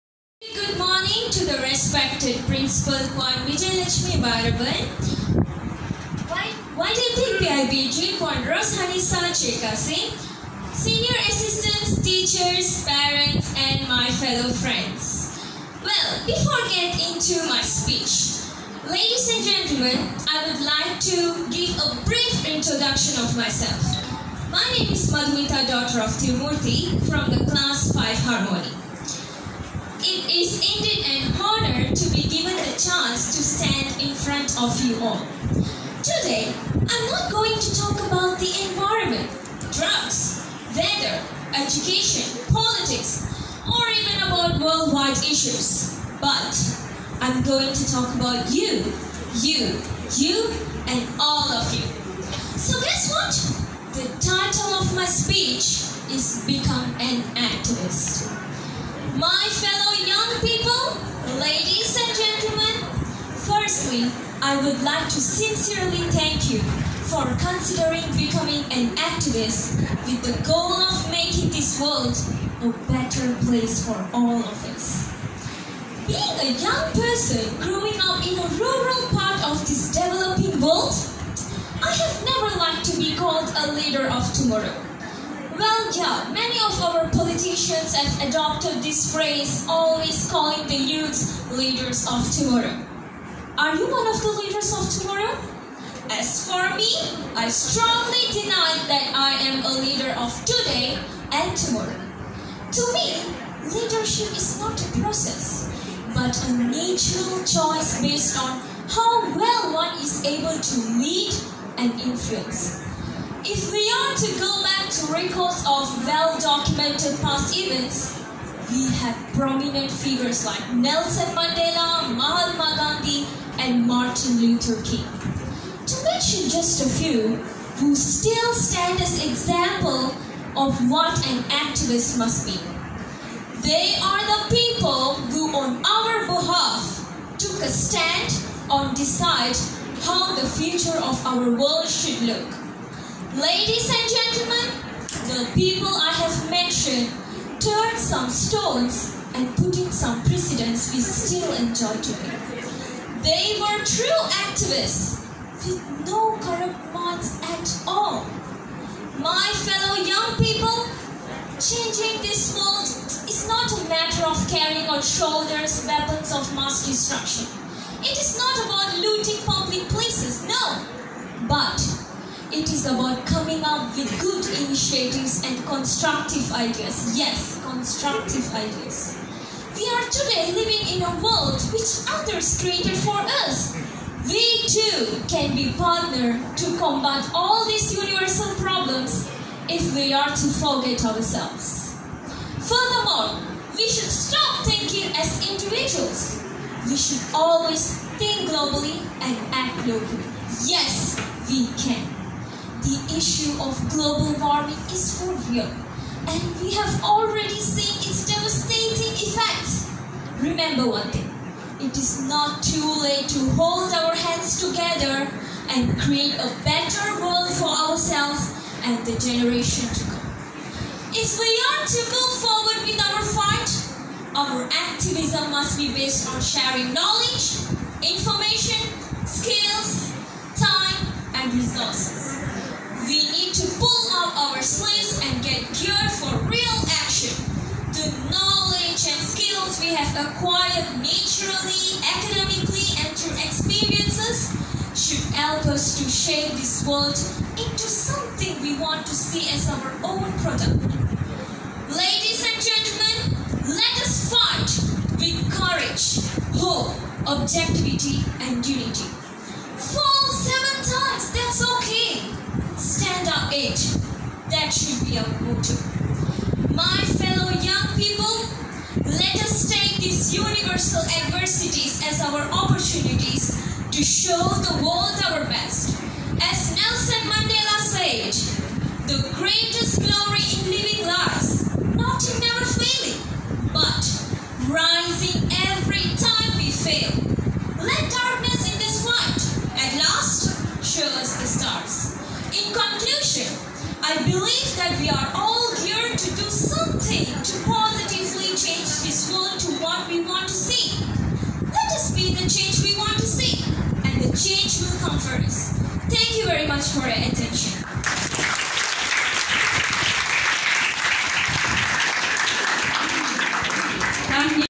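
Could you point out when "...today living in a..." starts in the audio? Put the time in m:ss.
3:00.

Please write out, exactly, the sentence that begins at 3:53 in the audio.
We need to pull out our sleeves and get geared for real action.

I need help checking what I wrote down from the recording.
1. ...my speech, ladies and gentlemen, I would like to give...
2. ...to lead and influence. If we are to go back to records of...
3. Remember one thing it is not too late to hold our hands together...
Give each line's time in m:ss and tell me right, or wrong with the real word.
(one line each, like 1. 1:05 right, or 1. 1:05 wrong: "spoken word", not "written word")
1. 0:17 right
2. 1:50 right
3. 3:30 right.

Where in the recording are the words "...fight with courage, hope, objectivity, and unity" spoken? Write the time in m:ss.
4:14.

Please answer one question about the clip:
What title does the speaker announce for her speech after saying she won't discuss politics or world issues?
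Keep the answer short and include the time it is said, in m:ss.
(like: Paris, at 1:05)
Become an Activist, at 0:56.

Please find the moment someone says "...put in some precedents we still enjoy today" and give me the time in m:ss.
2:29.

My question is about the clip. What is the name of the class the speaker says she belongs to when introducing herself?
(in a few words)
5 Harmony.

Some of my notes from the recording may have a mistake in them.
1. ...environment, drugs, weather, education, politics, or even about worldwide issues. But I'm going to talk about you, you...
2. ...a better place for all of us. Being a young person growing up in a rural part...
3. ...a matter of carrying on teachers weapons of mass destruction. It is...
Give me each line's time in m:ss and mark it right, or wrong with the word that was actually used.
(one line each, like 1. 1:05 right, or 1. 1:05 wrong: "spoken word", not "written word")
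1. 0:38 right
2. 1:12 right
3. 2:43 wrong: "shoulders", not "teachers".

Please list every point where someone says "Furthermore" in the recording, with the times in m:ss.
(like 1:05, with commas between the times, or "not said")
3:12.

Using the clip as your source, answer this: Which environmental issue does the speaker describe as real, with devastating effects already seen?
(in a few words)
global warming.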